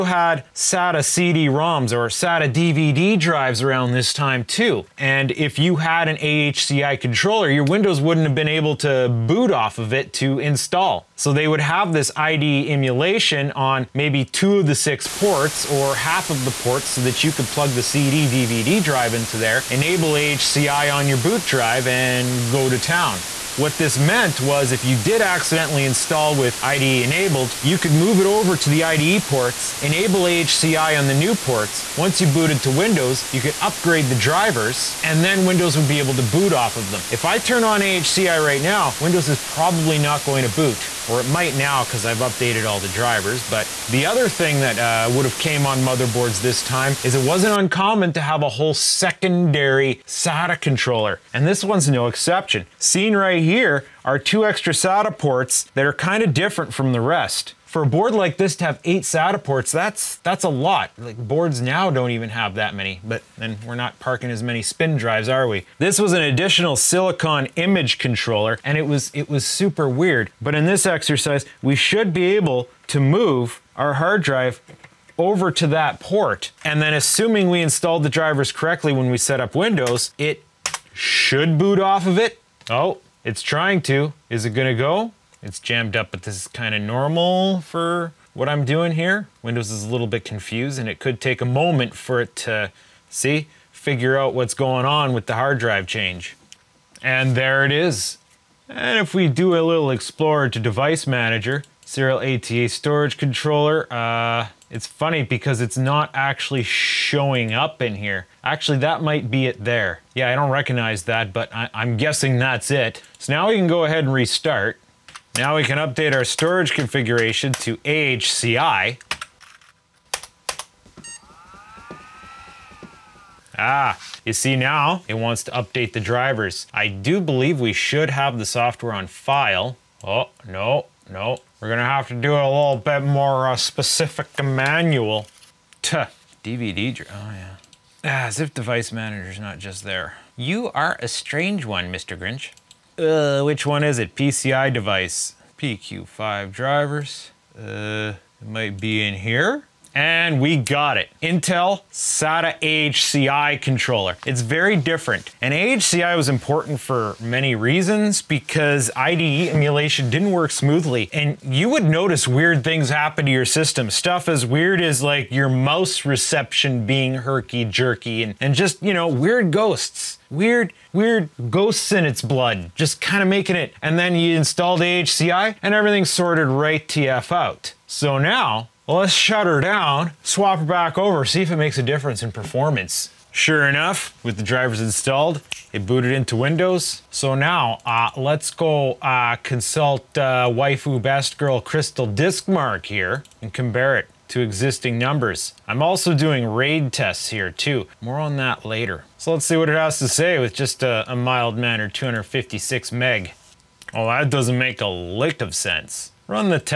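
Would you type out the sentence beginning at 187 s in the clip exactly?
So now, uh, let's go uh, consult uh, waifu best girl Crystal Disk Mark here and compare it to existing numbers.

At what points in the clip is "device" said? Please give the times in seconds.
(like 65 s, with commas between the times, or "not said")
100 s, 138 s, 144 s.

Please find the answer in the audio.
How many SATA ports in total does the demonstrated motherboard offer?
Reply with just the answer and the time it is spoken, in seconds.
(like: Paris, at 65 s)
8, at 58 s.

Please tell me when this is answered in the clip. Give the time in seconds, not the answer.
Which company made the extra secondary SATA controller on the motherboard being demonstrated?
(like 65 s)
66 s.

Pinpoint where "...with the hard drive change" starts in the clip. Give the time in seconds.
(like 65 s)
95 s.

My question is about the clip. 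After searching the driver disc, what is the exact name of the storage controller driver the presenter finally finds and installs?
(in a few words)
Intel SATA AHCI controller.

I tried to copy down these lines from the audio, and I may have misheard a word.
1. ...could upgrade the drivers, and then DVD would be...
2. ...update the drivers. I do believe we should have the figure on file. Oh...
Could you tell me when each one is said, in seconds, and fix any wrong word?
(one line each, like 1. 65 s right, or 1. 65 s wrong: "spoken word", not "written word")
1. 33 s wrong: "Windows", not "DVD"
2. 125 s wrong: "software", not "figure".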